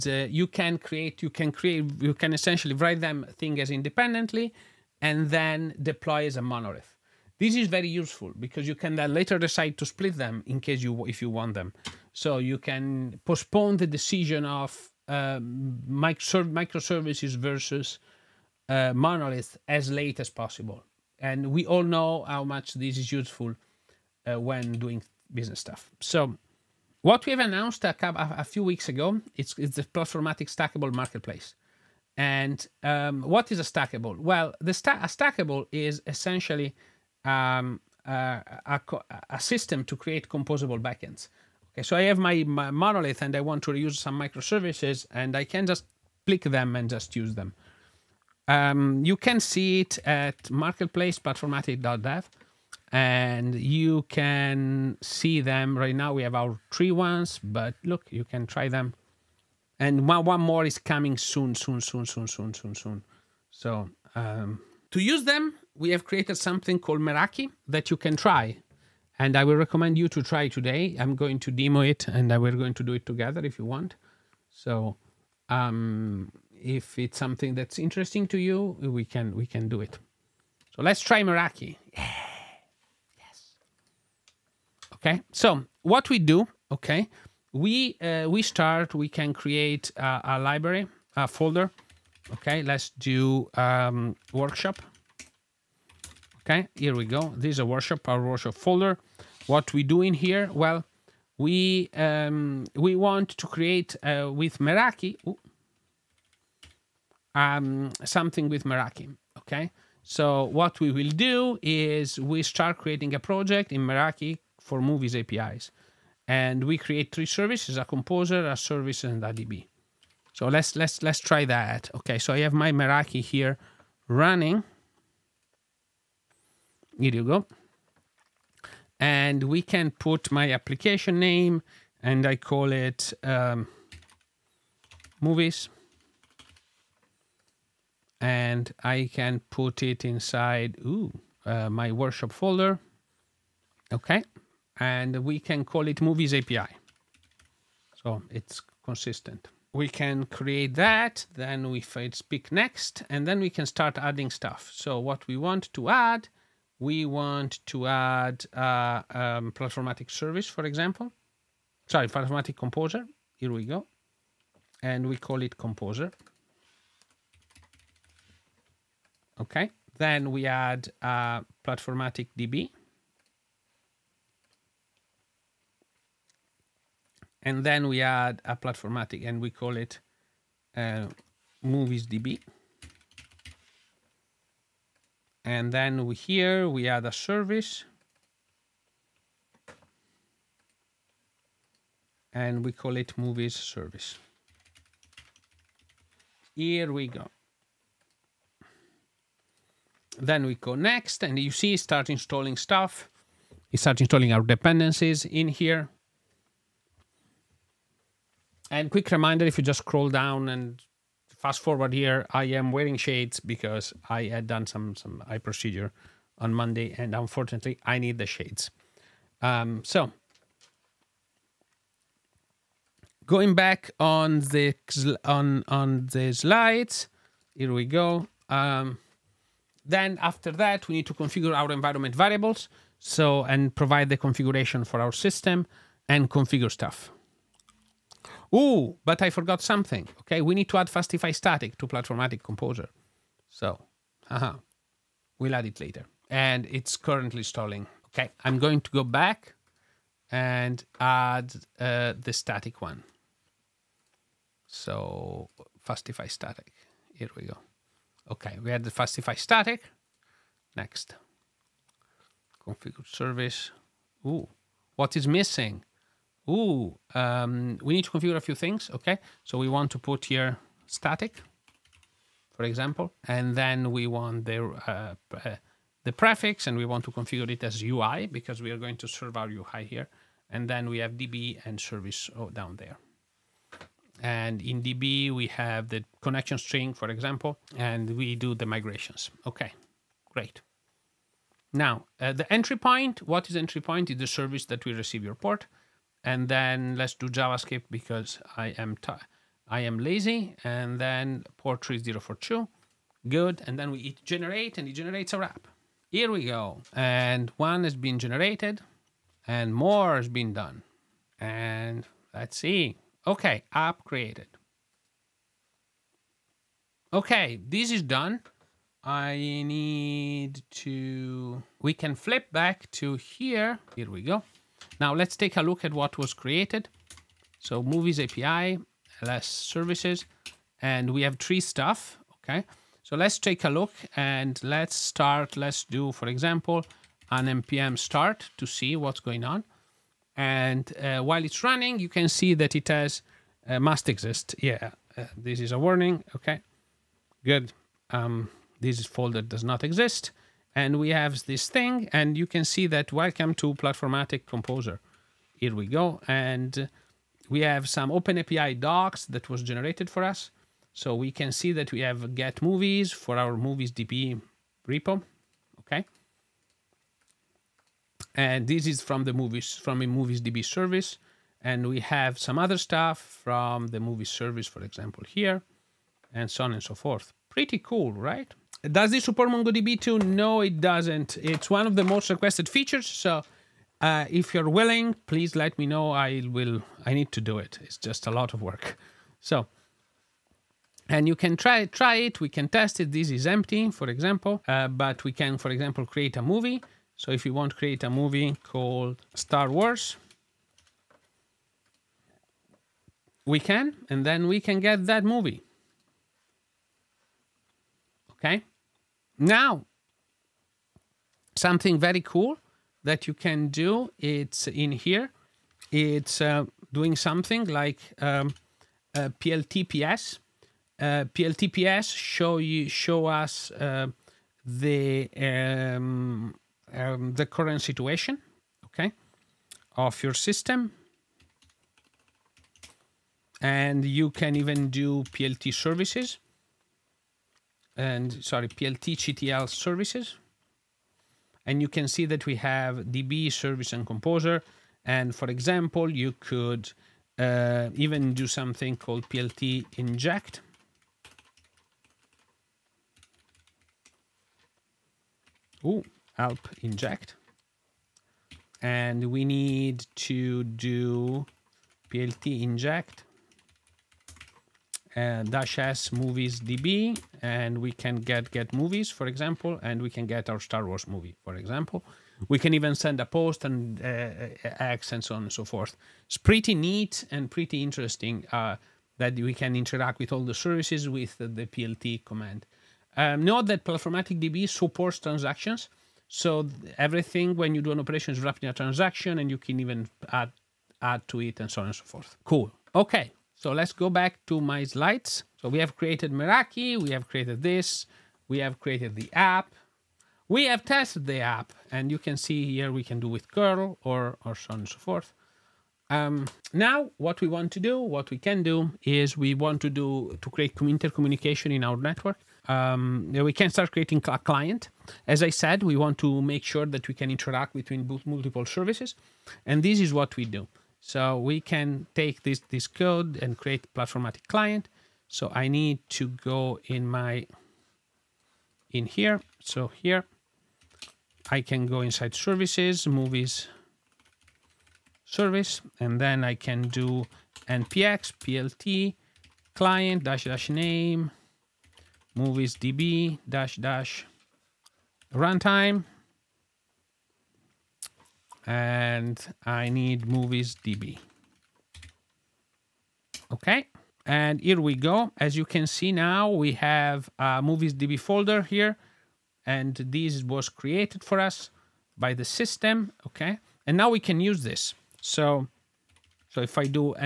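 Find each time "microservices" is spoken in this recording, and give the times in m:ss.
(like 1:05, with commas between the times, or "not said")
0:15, 0:44.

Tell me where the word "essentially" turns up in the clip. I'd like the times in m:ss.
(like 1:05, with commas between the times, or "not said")
0:02, 0:36.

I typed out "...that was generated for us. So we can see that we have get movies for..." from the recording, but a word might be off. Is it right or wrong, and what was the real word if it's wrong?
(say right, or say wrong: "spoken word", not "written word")
right.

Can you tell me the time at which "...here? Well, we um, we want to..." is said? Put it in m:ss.
1:40.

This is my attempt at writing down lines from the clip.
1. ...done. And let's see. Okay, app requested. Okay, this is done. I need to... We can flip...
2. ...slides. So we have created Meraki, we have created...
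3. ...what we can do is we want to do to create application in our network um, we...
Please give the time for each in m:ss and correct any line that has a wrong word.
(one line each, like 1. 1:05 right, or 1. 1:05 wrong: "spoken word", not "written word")
1. 5:10 wrong: "created", not "requested"
2. 8:14 right
3. 8:27 wrong: "intercommunication", not "application".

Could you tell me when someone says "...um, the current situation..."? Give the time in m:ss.
7:06.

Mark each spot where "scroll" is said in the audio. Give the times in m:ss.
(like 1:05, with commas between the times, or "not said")
3:29.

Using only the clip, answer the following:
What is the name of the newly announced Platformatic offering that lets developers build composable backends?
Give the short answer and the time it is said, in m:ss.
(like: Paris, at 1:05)
Stackable Marketplace, at 0:30.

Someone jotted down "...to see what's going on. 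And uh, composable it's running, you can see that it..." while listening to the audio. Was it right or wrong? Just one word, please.
wrong.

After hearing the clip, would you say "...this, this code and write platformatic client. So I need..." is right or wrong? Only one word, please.
wrong.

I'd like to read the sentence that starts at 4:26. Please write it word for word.
Ooh, um, we need to configure a few things, okay?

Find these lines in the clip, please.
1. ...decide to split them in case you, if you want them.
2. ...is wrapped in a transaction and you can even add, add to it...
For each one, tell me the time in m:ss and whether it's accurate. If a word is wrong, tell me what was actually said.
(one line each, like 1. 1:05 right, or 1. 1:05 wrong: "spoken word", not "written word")
1. 0:09 right
2. 8:08 right.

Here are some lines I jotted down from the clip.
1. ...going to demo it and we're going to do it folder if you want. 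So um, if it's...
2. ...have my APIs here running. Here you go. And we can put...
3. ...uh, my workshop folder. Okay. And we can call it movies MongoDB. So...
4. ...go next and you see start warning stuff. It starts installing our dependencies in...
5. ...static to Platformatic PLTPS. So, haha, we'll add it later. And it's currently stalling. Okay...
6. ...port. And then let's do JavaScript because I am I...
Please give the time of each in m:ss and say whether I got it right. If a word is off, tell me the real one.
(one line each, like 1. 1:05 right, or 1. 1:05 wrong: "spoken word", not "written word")
1. 1:11 wrong: "together", not "folder"
2. 2:02 wrong: "Meraki", not "APIs"
3. 2:21 wrong: "API", not "MongoDB"
4. 3:20 wrong: "installing", not "warning"
5. 4:01 wrong: "Composer", not "PLTPS"
6. 4:55 right.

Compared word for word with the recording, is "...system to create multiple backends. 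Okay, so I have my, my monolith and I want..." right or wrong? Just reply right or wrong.
wrong.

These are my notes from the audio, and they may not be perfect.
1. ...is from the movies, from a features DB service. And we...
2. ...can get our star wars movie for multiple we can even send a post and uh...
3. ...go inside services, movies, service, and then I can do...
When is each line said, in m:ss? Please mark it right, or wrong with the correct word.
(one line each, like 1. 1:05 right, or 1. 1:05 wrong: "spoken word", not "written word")
1. 6:08 wrong: "movies", not "features"
2. 7:50 wrong: "example", not "multiple"
3. 8:51 right.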